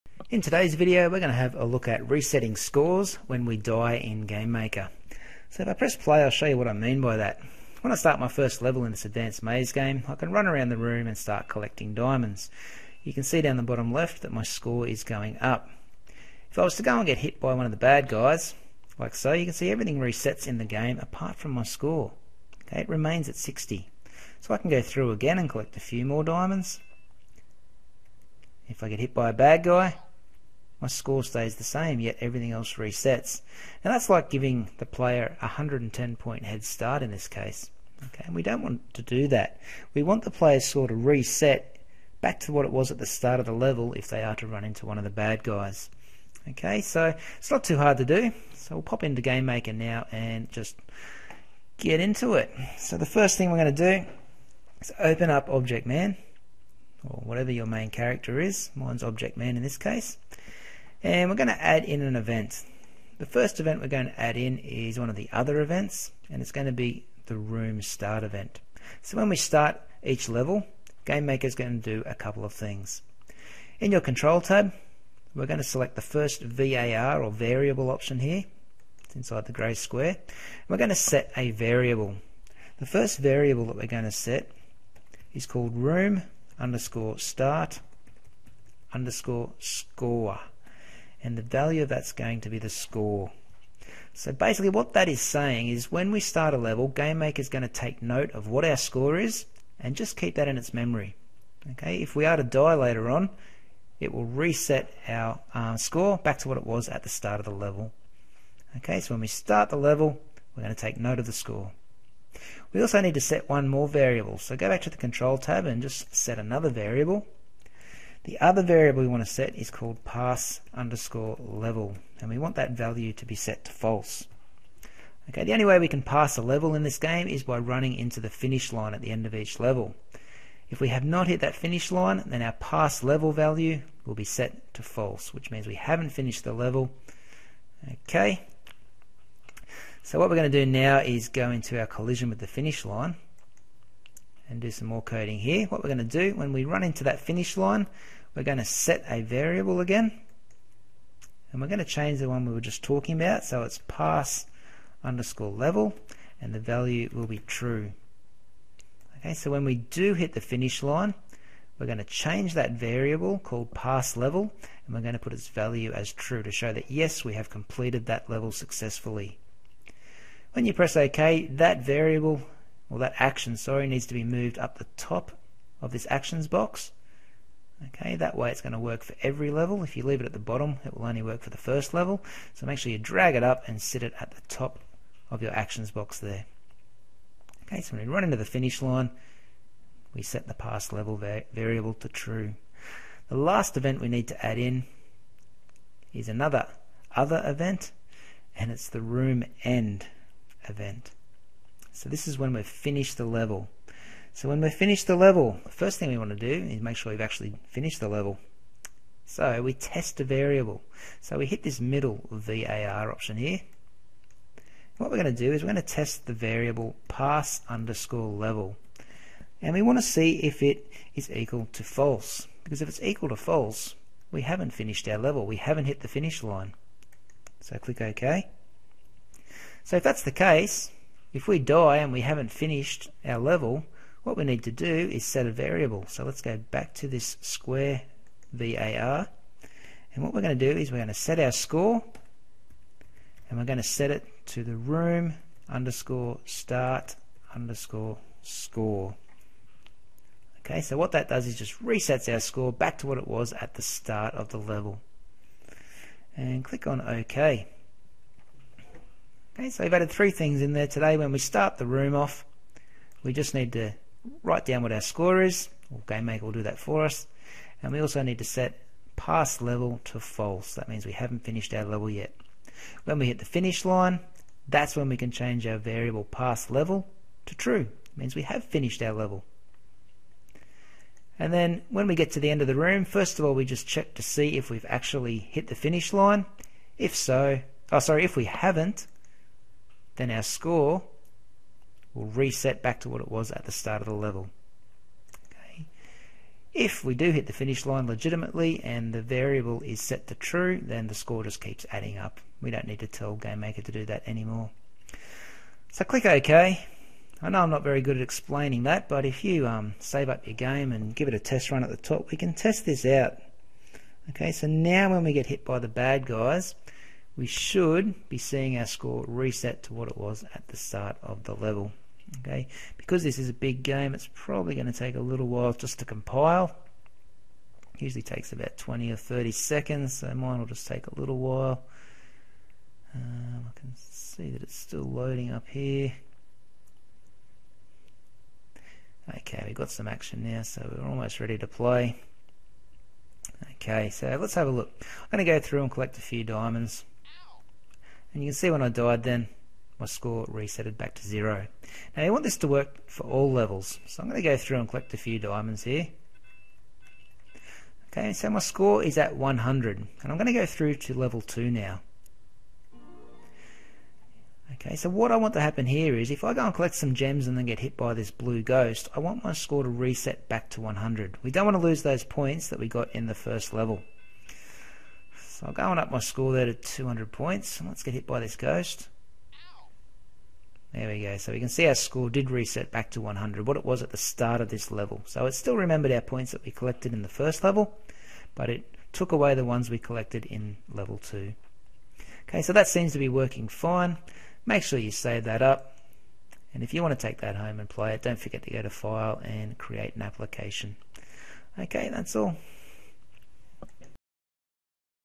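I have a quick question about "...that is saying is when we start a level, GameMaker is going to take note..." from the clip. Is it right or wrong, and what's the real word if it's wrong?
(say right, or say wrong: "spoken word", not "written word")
right.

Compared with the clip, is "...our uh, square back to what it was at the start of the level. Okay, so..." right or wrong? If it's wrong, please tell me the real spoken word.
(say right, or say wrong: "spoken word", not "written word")
wrong: "score", not "square".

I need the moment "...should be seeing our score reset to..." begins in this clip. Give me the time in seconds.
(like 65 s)
317 s.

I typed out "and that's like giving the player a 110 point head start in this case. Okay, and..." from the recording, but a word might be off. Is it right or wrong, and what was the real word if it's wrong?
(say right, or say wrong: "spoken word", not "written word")
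right.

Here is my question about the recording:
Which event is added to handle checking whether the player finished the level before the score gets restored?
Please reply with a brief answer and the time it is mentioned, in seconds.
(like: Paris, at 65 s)
room end event, at 199 s.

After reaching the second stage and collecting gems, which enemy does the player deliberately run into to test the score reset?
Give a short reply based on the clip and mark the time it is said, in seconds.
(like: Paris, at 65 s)
blue ghost, at 368 s.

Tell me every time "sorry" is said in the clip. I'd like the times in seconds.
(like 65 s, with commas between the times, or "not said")
173 s, 287 s.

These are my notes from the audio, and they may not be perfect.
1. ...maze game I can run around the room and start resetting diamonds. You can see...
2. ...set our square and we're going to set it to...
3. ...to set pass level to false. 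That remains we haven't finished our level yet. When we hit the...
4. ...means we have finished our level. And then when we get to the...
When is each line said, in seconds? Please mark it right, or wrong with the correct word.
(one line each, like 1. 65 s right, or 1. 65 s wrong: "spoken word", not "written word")
1. 9 s wrong: "collecting", not "resetting"
2. 241 s wrong: "score", not "square"
3. 268 s wrong: "means", not "remains"
4. 278 s right.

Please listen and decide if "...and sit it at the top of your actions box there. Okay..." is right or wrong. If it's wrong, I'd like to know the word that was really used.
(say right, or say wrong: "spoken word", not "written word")
right.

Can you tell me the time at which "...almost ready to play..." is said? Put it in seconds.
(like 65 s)
341 s.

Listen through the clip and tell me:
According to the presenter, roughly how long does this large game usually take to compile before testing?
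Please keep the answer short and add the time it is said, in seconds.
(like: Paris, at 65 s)
20 or 30 seconds, at 328 s.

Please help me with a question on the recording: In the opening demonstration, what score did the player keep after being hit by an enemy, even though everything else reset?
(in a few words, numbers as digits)
60.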